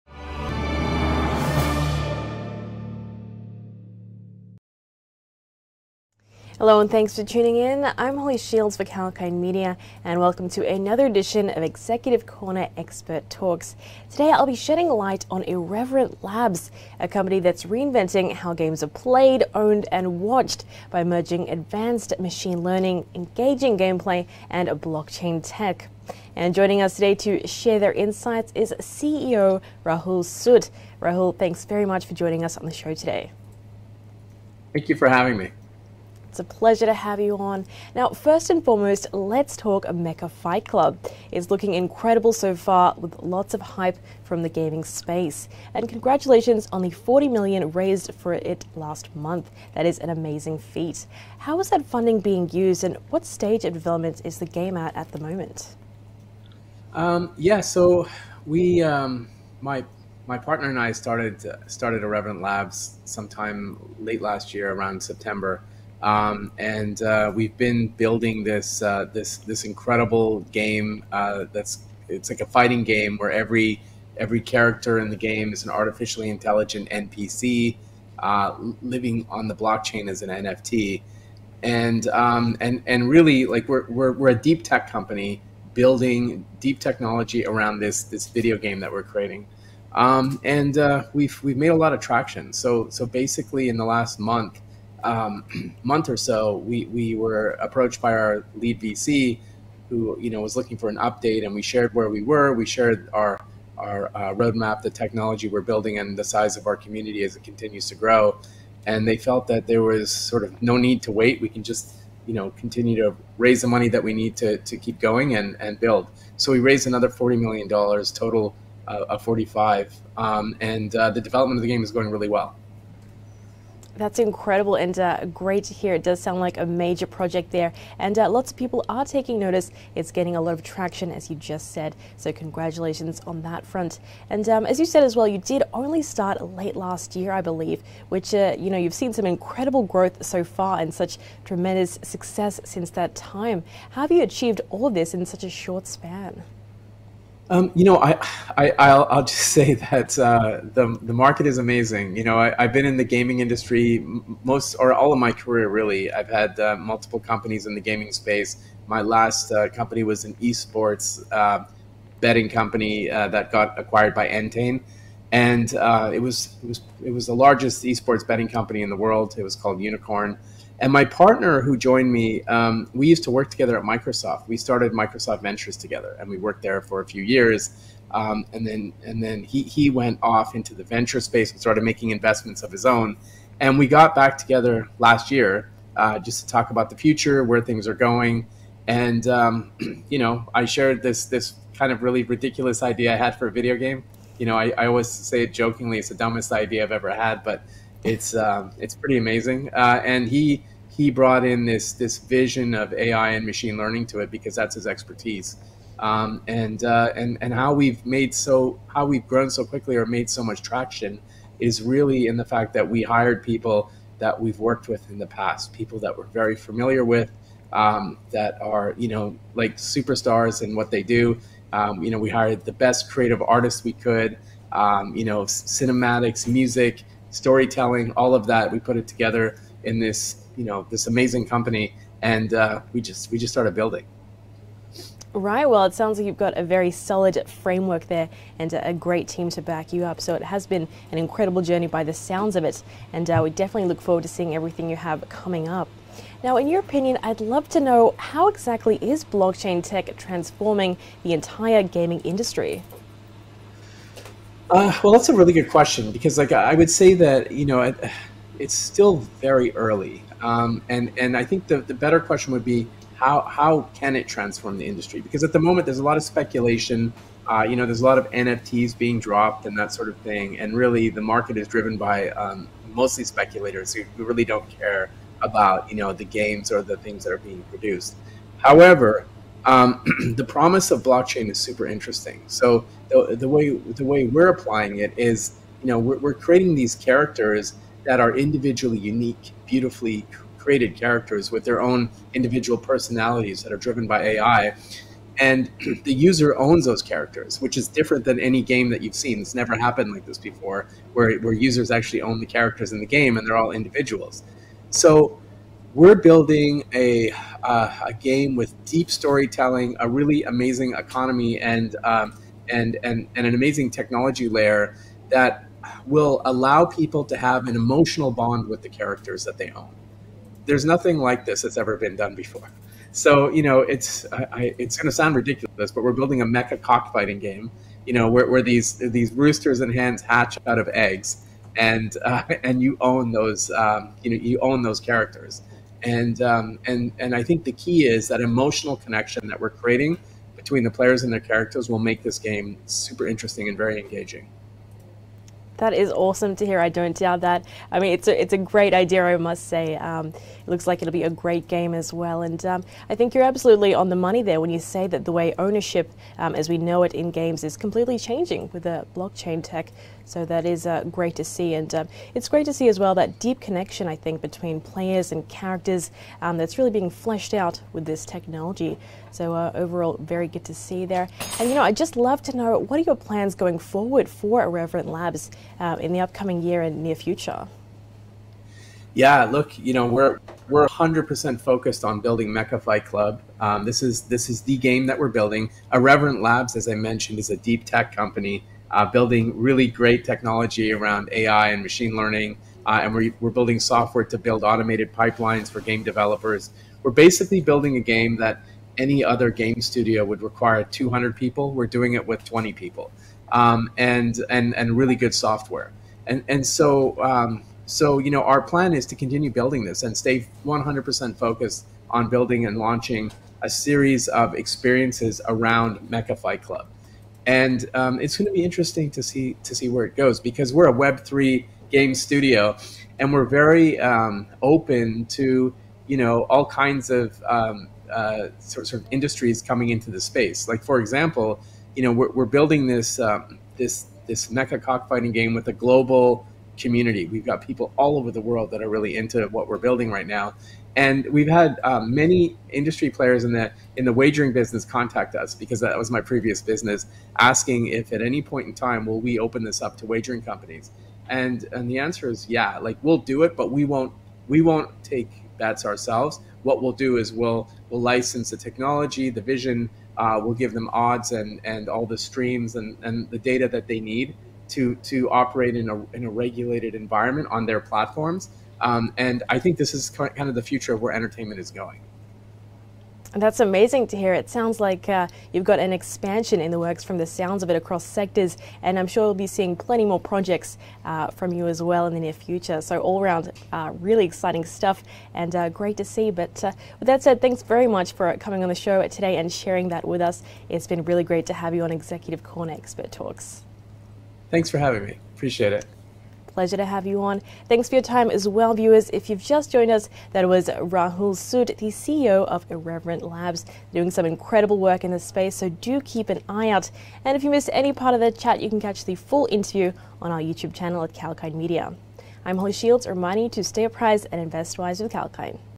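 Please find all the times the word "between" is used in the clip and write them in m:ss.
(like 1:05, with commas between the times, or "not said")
5:40, 6:04.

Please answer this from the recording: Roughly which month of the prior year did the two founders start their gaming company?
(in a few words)
September.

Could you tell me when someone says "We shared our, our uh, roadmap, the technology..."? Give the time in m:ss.
1:42.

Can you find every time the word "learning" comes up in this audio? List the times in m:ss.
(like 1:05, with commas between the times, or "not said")
0:22, 3:23, 6:32.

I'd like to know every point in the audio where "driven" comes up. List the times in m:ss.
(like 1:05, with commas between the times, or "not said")
4:31, 4:53.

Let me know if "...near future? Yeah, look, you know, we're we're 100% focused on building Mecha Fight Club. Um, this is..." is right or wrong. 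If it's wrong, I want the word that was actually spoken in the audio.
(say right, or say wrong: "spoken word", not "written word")
right.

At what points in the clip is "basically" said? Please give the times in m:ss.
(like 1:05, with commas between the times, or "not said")
1:33, 6:37.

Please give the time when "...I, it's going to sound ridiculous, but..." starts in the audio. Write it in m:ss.
5:24.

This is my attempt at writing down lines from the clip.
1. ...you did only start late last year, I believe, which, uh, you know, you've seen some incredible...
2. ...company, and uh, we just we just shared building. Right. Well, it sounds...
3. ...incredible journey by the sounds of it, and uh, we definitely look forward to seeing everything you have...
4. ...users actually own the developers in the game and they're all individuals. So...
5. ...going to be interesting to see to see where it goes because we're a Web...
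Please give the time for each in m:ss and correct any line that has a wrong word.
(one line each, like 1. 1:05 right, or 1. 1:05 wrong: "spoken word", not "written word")
1. 2:15 right
2. 3:51 wrong: "started", not "shared"
3. 4:01 right
4. 5:01 wrong: "characters", not "developers"
5. 6:58 right.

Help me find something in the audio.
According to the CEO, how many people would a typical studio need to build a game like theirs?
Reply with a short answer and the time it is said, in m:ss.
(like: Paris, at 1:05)
200, at 6:40.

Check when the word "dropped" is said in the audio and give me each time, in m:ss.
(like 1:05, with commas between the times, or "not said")
4:29.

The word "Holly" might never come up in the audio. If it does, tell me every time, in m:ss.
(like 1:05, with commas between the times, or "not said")
0:08, 8:32.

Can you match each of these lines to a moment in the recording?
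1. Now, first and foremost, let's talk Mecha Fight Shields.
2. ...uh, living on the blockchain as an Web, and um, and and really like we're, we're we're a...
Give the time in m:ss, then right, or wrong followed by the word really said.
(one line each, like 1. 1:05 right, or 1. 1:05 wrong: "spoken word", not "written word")
1. 0:37 wrong: "Club", not "Shields"
2. 1:18 wrong: "NFT", not "Web".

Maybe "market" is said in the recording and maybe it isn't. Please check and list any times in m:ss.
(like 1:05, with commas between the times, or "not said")
2:31, 4:31.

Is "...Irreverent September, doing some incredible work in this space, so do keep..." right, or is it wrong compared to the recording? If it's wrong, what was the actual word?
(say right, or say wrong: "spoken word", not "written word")
wrong: "Labs", not "September".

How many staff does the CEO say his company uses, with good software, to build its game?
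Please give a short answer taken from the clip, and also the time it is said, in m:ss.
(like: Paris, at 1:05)
20, at 6:42.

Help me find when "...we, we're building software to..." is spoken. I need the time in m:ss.
6:33.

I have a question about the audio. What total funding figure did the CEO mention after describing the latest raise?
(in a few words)
45.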